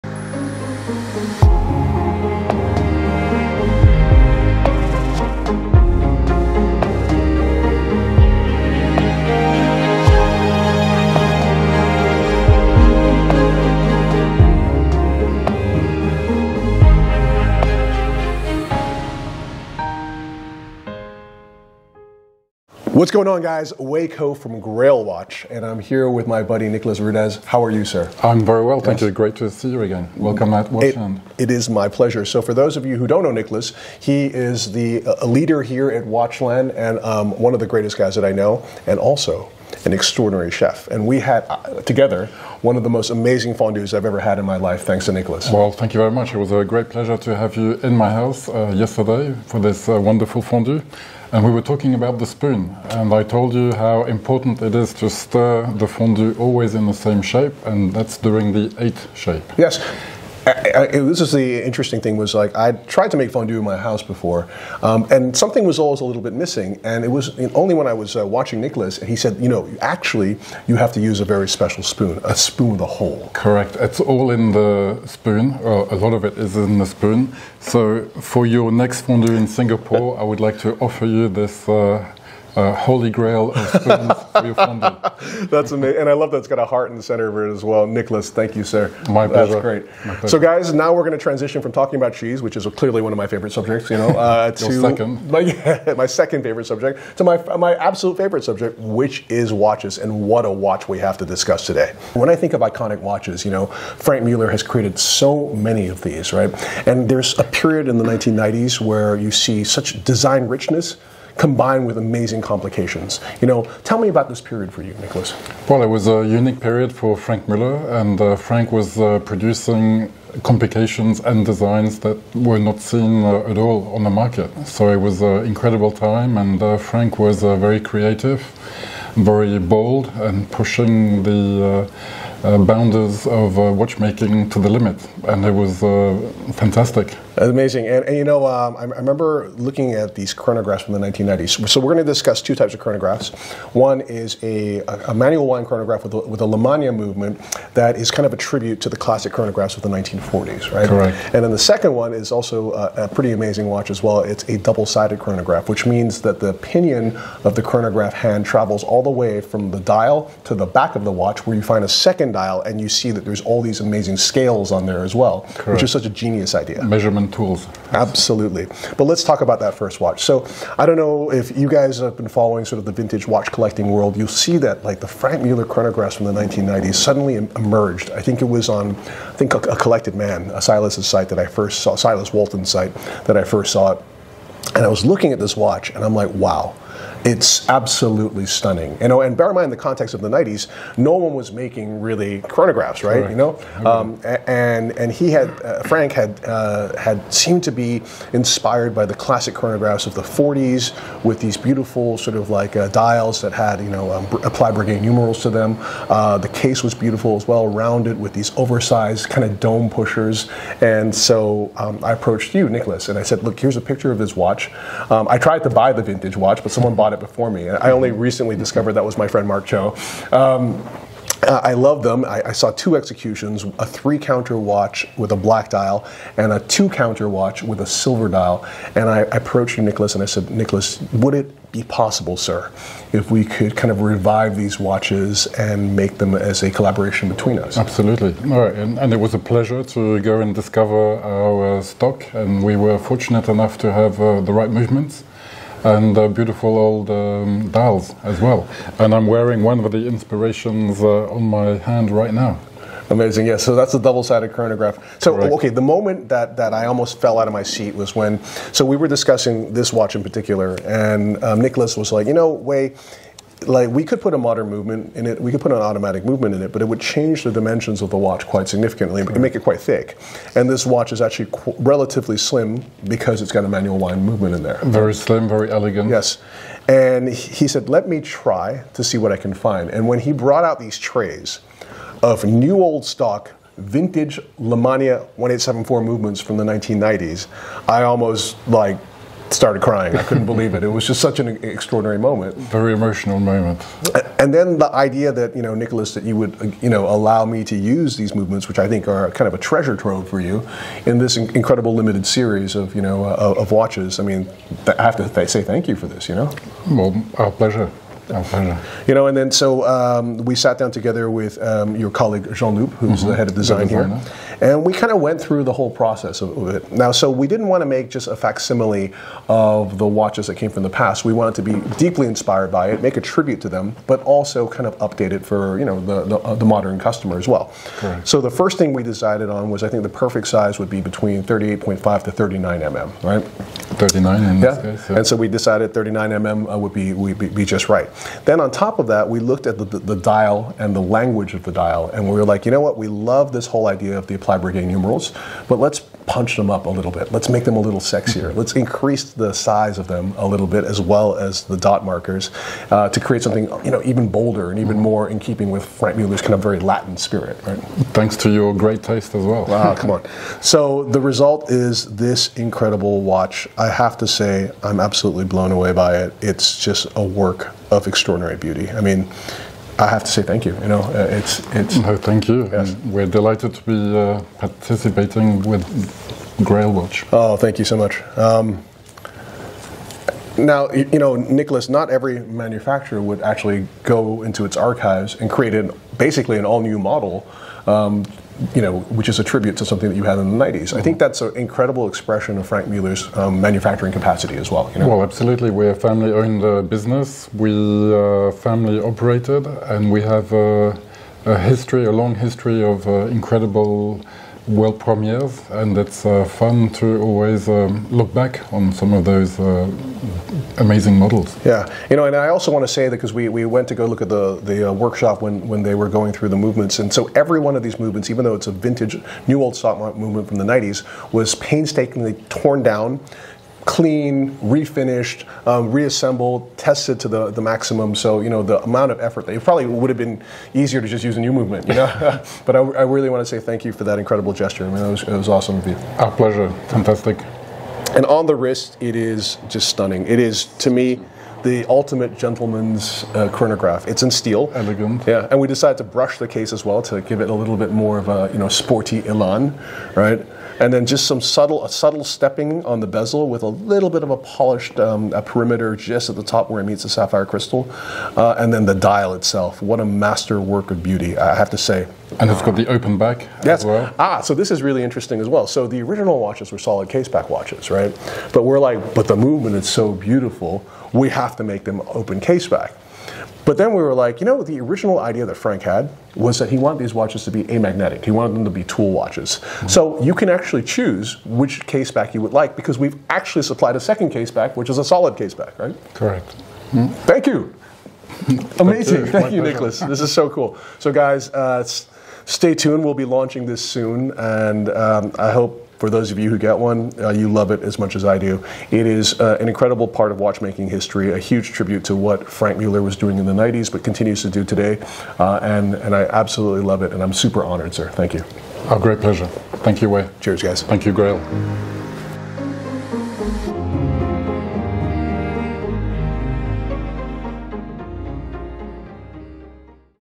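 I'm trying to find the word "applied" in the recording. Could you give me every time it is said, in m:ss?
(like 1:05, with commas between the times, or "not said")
3:24, 5:44.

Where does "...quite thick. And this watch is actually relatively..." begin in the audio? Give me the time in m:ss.
4:29.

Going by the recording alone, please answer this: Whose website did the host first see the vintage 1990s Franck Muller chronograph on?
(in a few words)
Silas Walton.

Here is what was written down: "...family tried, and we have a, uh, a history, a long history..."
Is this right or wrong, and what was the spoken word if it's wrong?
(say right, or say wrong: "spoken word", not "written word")
wrong: "operated", not "tried".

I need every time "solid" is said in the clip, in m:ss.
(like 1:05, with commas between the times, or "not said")
7:46, 8:05.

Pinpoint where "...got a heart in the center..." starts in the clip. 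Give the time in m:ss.
1:26.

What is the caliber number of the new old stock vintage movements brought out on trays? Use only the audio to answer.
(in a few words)
1874.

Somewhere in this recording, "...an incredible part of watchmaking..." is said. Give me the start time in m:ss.
8:19.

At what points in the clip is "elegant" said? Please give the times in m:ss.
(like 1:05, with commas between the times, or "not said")
4:35, 7:24.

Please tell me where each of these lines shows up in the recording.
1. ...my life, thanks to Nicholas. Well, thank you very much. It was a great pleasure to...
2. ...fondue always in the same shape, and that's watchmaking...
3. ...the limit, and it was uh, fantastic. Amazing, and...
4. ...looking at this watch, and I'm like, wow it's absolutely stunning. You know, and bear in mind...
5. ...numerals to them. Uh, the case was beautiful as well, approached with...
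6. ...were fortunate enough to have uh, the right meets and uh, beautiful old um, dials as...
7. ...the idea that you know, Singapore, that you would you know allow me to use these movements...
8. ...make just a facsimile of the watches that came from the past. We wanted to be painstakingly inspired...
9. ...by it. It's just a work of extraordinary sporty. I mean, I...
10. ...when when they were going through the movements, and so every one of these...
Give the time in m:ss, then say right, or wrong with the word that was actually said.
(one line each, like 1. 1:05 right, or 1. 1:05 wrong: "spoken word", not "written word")
1. 0:44 right
2. 0:55 wrong: "during", not "watchmaking"
3. 2:14 right
4. 3:05 right
5. 3:25 wrong: "rounded", not "approached"
6. 4:02 wrong: "movements", not "meets"
7. 4:54 wrong: "Nicholas", not "Singapore"
8. 5:17 wrong: "deeply", not "painstakingly"
9. 6:05 wrong: "beauty", not "sporty"
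10. 6:55 right.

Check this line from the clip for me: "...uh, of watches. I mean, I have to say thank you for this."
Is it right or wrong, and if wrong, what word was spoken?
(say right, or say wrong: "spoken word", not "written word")
right.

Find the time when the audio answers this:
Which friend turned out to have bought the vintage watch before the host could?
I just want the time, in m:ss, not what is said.
3:39.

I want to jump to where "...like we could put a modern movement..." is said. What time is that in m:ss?
4:23.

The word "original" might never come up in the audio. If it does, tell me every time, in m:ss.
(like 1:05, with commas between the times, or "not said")
7:46, 7:54.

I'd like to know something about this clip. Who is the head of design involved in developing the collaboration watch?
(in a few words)
Jean Loup.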